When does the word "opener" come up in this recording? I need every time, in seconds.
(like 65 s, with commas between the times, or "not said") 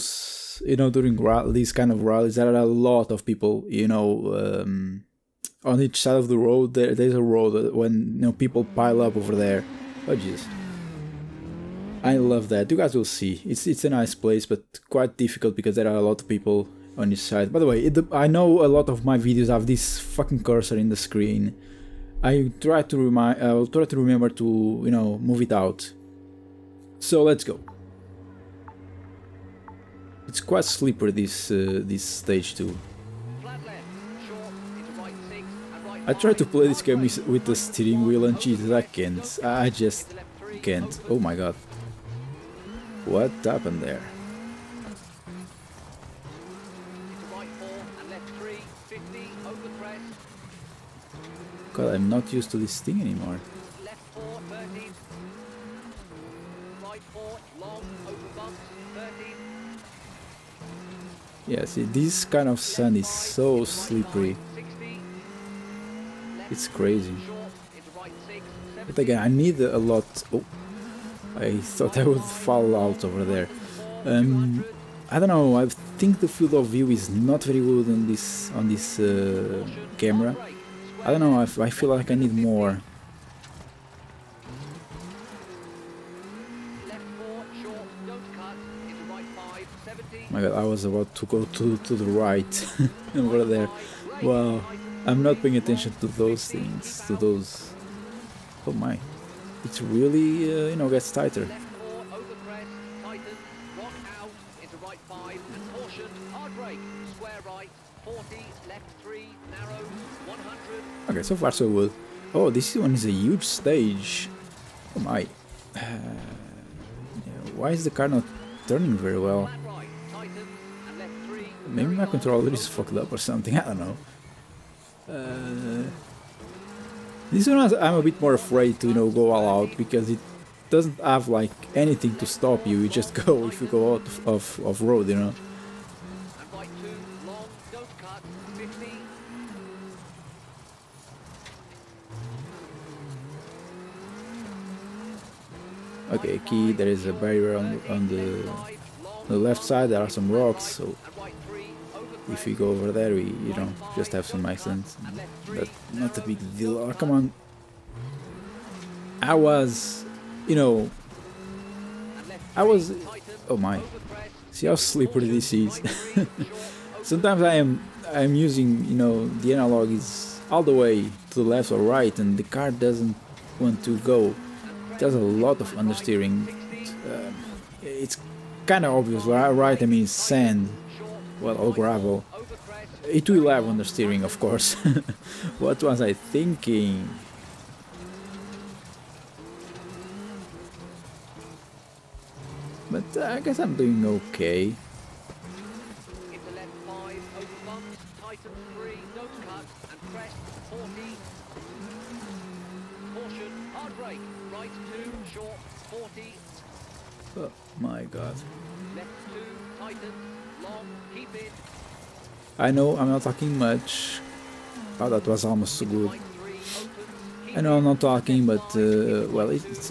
not said.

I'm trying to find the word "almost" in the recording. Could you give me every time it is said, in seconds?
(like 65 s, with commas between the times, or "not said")
215 s.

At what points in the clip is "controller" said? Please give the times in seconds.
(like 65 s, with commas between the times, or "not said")
122 s.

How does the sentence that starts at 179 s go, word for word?
I mean, sand well, all gravel.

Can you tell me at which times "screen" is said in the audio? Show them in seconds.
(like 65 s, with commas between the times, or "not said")
20 s.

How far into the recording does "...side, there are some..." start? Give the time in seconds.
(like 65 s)
149 s.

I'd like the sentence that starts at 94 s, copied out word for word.
Wow, I'm not paying attention to those things, to those...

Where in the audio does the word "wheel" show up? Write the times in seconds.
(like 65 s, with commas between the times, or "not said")
38 s.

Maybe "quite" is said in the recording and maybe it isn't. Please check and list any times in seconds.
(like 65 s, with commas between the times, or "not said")
14 s, 30 s.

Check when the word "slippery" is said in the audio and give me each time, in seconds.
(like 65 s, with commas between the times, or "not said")
63 s, 164 s.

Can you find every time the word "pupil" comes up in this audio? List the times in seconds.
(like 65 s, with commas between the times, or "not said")
not said.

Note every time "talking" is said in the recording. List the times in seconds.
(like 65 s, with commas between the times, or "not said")
213 s, 217 s.